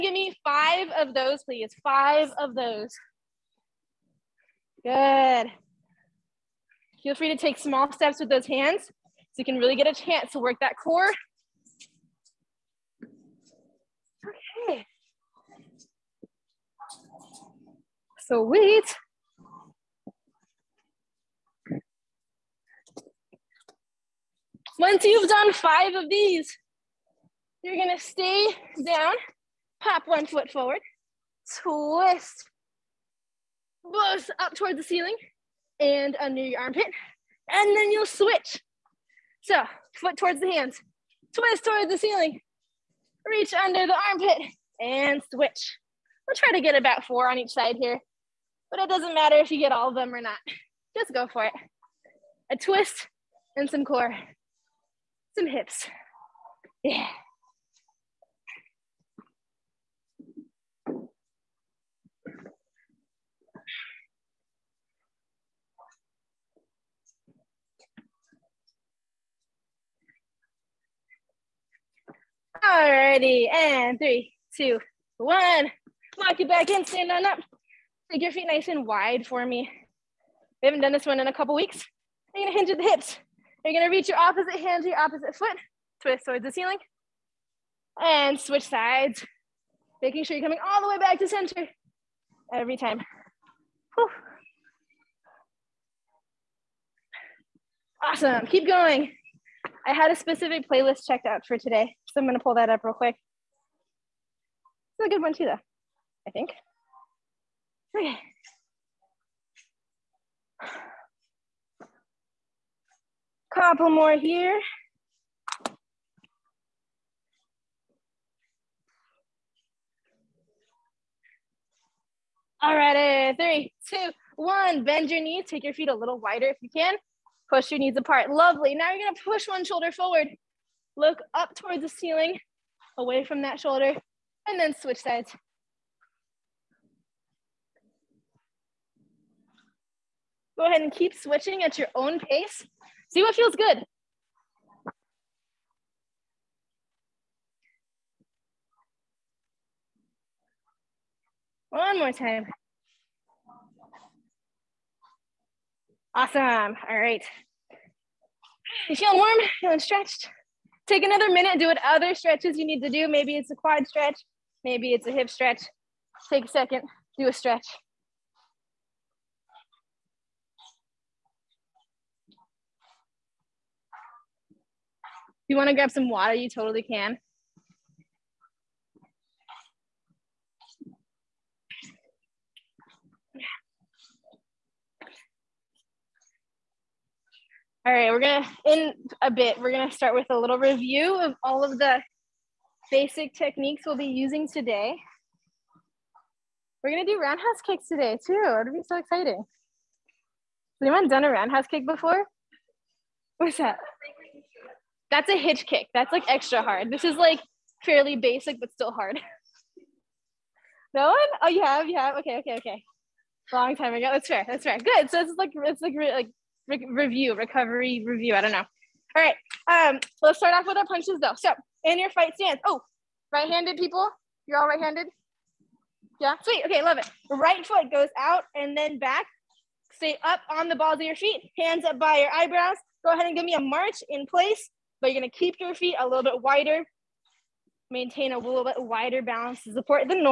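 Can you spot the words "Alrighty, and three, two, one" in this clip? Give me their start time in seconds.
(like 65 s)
72 s.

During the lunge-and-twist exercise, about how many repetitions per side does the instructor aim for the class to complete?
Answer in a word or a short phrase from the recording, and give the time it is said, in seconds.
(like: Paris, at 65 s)
4, at 47 s.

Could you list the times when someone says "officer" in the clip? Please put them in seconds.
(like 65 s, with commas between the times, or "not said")
not said.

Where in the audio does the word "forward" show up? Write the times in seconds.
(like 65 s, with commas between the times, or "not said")
30 s, 129 s.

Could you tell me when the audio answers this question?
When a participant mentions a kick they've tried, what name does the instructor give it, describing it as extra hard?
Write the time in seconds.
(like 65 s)
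205 s.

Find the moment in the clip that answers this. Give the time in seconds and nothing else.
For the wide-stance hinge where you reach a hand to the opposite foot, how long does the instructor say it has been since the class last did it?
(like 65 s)
81 s.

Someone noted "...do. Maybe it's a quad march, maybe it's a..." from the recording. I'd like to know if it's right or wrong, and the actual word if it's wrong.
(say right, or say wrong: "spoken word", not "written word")
wrong: "stretch", not "march".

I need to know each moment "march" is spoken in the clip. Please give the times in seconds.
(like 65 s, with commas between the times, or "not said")
233 s.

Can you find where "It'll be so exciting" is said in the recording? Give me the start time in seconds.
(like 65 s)
198 s.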